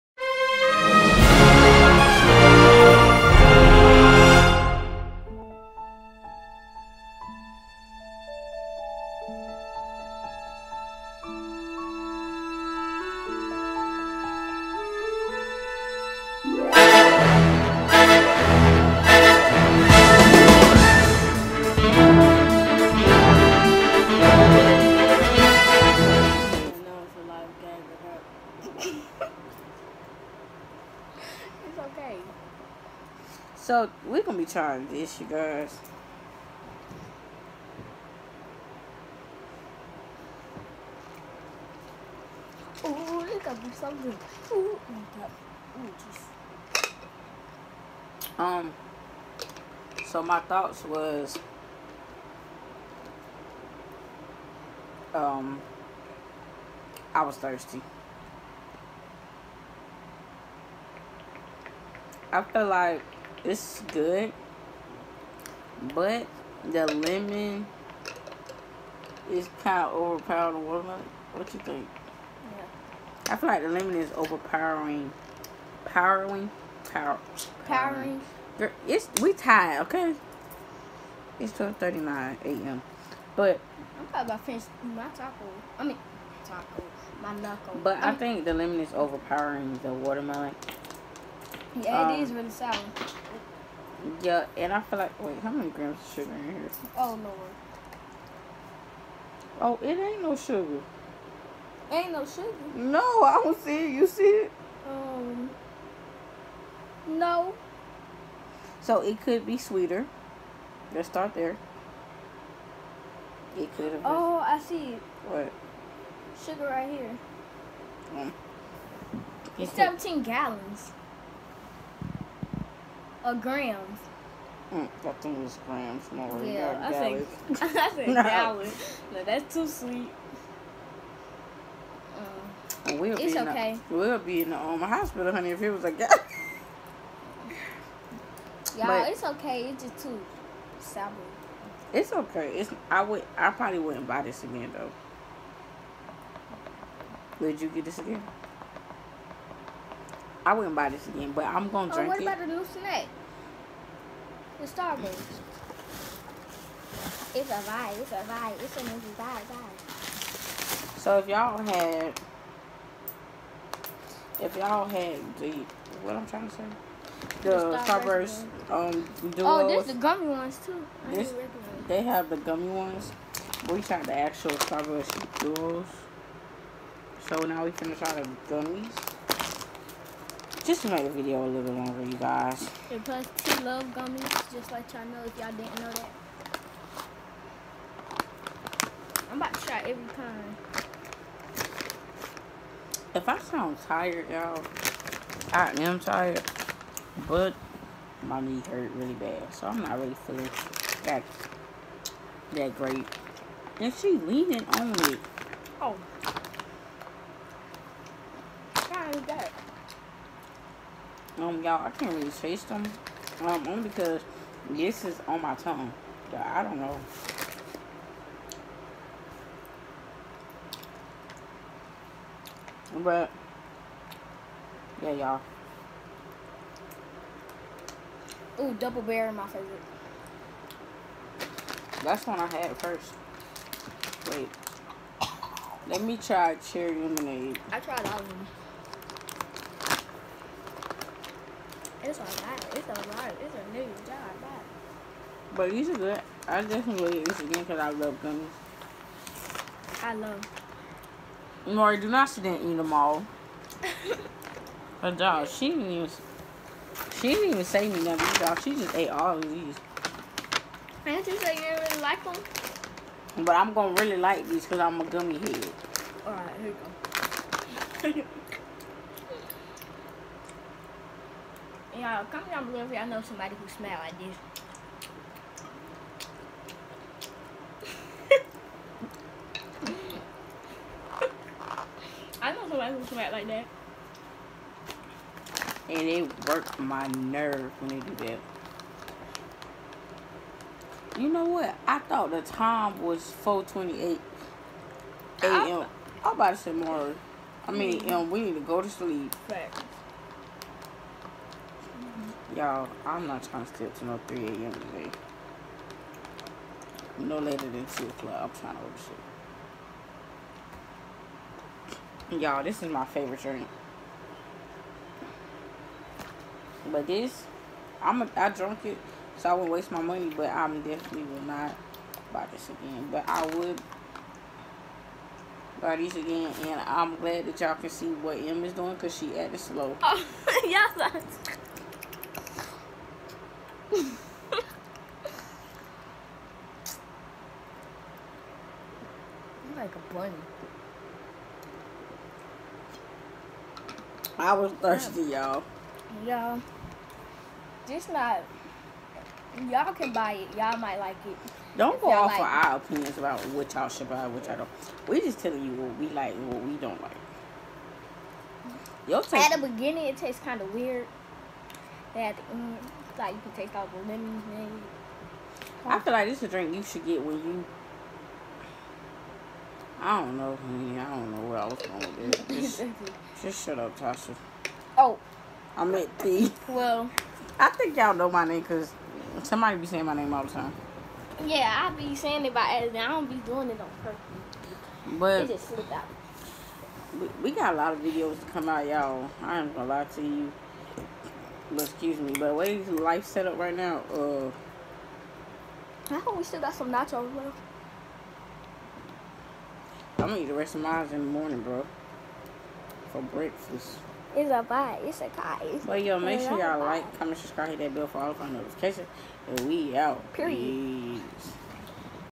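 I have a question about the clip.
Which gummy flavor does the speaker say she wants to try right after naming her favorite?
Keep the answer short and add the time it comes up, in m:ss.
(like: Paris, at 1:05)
cherry lemonade, at 3:56.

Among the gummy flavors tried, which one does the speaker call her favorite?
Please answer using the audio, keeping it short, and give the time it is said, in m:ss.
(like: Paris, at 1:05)
double bear, at 3:48.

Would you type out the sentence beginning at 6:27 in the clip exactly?
We, we got a lot of videos to come out, y'all.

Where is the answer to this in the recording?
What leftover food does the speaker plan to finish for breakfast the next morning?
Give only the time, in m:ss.
6:36.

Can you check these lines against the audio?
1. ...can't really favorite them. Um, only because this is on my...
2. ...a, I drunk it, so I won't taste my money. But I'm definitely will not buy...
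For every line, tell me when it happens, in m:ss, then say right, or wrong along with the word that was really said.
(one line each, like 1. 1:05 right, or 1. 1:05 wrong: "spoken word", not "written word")
1. 3:31 wrong: "taste", not "favorite"
2. 5:18 wrong: "waste", not "taste".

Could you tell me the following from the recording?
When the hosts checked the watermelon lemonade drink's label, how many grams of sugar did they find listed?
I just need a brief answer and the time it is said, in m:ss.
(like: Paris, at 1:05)
17, at 1:59.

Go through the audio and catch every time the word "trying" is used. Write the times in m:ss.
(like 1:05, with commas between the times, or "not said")
0:34, 2:46, 5:03, 5:08.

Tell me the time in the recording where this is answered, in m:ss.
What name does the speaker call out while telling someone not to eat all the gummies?
4:11.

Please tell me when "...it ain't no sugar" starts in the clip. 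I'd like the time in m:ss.
1:39.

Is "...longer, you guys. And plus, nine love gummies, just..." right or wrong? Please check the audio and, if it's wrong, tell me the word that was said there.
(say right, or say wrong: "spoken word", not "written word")
wrong: "two", not "nine".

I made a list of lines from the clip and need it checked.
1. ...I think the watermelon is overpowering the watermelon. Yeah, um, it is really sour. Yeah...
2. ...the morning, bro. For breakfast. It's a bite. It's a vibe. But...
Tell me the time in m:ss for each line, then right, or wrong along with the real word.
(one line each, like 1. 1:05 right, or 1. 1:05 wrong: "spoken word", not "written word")
1. 1:28 wrong: "lemon", not "watermelon"
2. 6:41 right.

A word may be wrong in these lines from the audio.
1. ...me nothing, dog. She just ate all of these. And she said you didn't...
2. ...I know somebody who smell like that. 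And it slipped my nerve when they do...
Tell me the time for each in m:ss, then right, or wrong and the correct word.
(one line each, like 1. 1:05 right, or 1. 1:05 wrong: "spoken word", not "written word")
1. 4:17 right
2. 4:42 wrong: "worked", not "slipped".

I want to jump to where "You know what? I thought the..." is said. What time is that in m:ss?
4:51.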